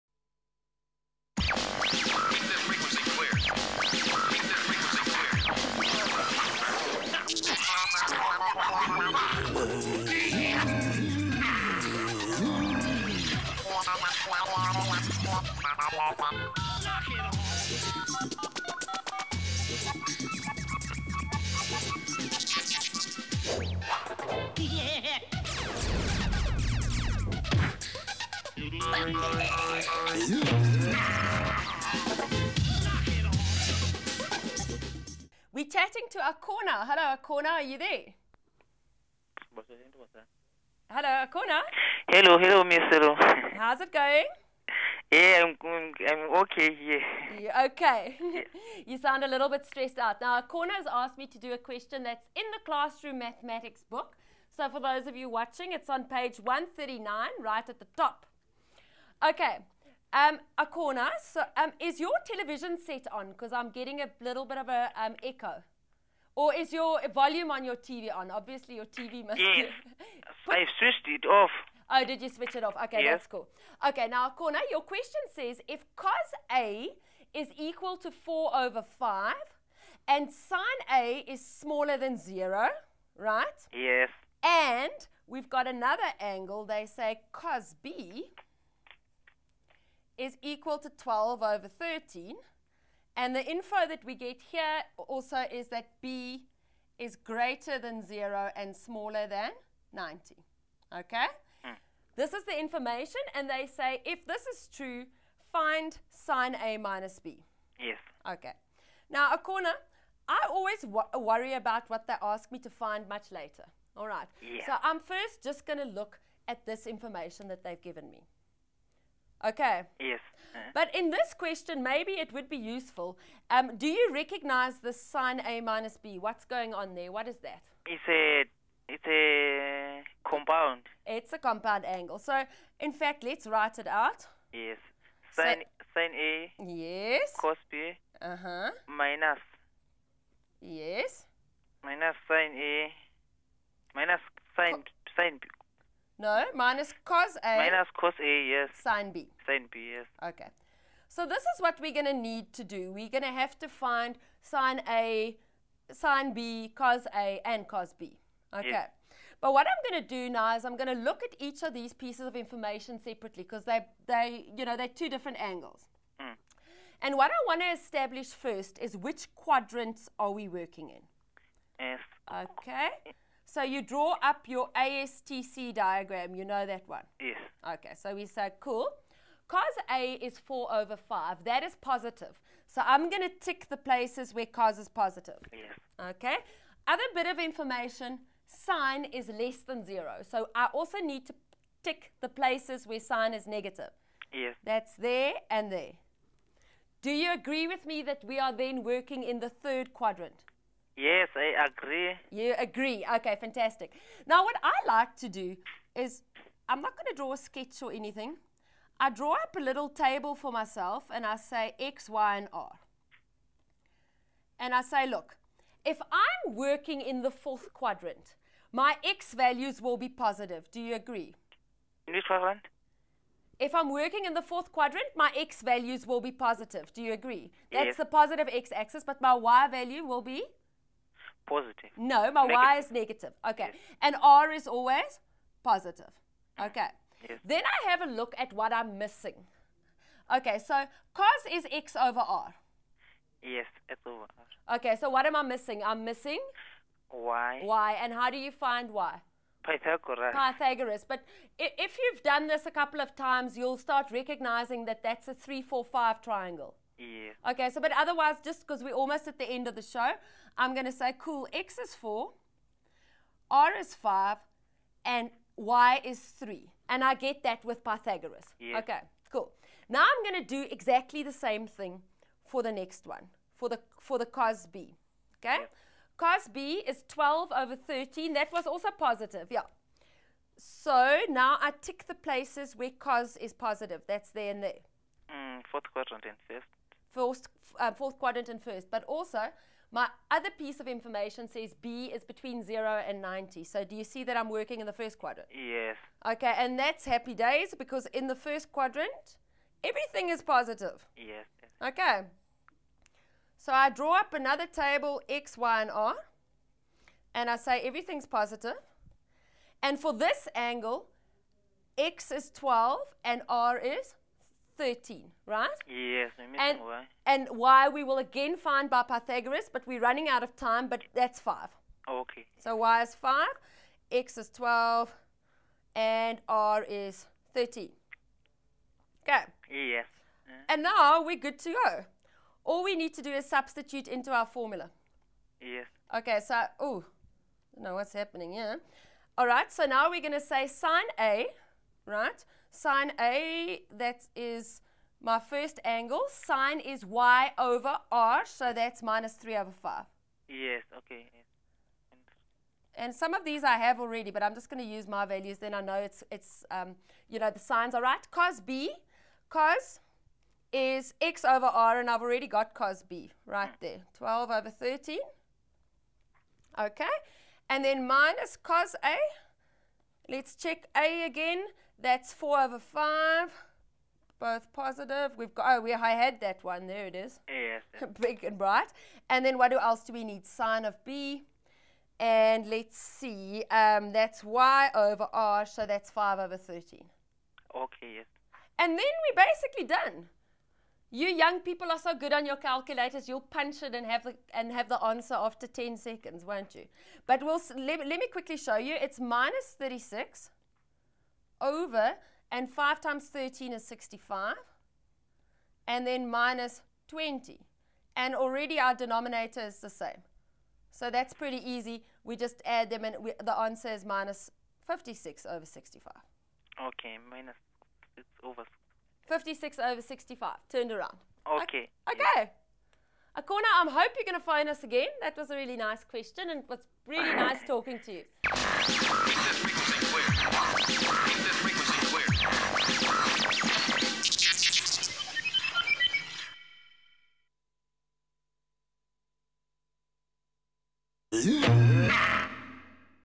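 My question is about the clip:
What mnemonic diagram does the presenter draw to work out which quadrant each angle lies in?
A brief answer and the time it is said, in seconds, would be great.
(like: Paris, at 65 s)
ASTC diagram, at 174 s.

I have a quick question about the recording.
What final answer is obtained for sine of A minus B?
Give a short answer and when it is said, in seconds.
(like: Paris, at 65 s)
-56/65, at 414 s.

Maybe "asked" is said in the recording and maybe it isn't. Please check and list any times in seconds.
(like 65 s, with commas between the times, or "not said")
50 s.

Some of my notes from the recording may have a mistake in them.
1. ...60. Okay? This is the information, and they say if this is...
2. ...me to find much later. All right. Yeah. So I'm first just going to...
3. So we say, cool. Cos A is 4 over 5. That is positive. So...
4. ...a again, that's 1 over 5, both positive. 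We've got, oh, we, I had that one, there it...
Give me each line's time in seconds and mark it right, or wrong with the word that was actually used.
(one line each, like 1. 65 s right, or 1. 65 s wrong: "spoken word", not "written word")
1. 99 s wrong: "90", not "60"
2. 112 s right
3. 177 s right
4. 370 s wrong: "4", not "1".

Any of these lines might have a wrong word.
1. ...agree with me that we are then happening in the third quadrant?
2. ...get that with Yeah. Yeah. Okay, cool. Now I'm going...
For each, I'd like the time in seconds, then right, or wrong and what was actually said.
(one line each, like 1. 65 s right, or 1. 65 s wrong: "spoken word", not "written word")
1. 197 s wrong: "working", not "happening"
2. 267 s wrong: "Pythagoras", not "Yeah".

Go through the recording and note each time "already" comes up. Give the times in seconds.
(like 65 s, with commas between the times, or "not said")
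353 s, 362 s, 408 s.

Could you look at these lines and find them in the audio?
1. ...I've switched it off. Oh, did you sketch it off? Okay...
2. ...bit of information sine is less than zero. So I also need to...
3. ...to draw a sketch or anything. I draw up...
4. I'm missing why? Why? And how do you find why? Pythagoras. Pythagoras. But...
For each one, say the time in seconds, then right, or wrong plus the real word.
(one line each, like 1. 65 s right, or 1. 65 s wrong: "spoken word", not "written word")
1. 70 s wrong: "switch", not "sketch"
2. 187 s right
3. 207 s right
4. 245 s right.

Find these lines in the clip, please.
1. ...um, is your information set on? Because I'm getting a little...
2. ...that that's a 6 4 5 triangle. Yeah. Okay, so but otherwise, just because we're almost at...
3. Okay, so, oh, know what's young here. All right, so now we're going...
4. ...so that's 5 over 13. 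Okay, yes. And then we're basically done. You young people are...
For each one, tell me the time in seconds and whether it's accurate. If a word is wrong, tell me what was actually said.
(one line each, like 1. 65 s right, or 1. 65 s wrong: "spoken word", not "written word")
1. 61 s wrong: "television", not "information"
2. 254 s wrong: "3", not "6"
3. 336 s wrong: "happening", not "young"
4. 385 s right.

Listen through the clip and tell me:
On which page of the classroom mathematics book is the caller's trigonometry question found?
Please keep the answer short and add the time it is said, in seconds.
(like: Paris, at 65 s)
139, at 56 s.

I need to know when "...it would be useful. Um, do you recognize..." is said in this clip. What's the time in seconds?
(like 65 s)
122 s.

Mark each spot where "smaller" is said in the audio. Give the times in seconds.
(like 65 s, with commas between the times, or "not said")
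81 s, 98 s.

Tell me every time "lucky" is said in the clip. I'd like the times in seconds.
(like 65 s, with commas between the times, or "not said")
not said.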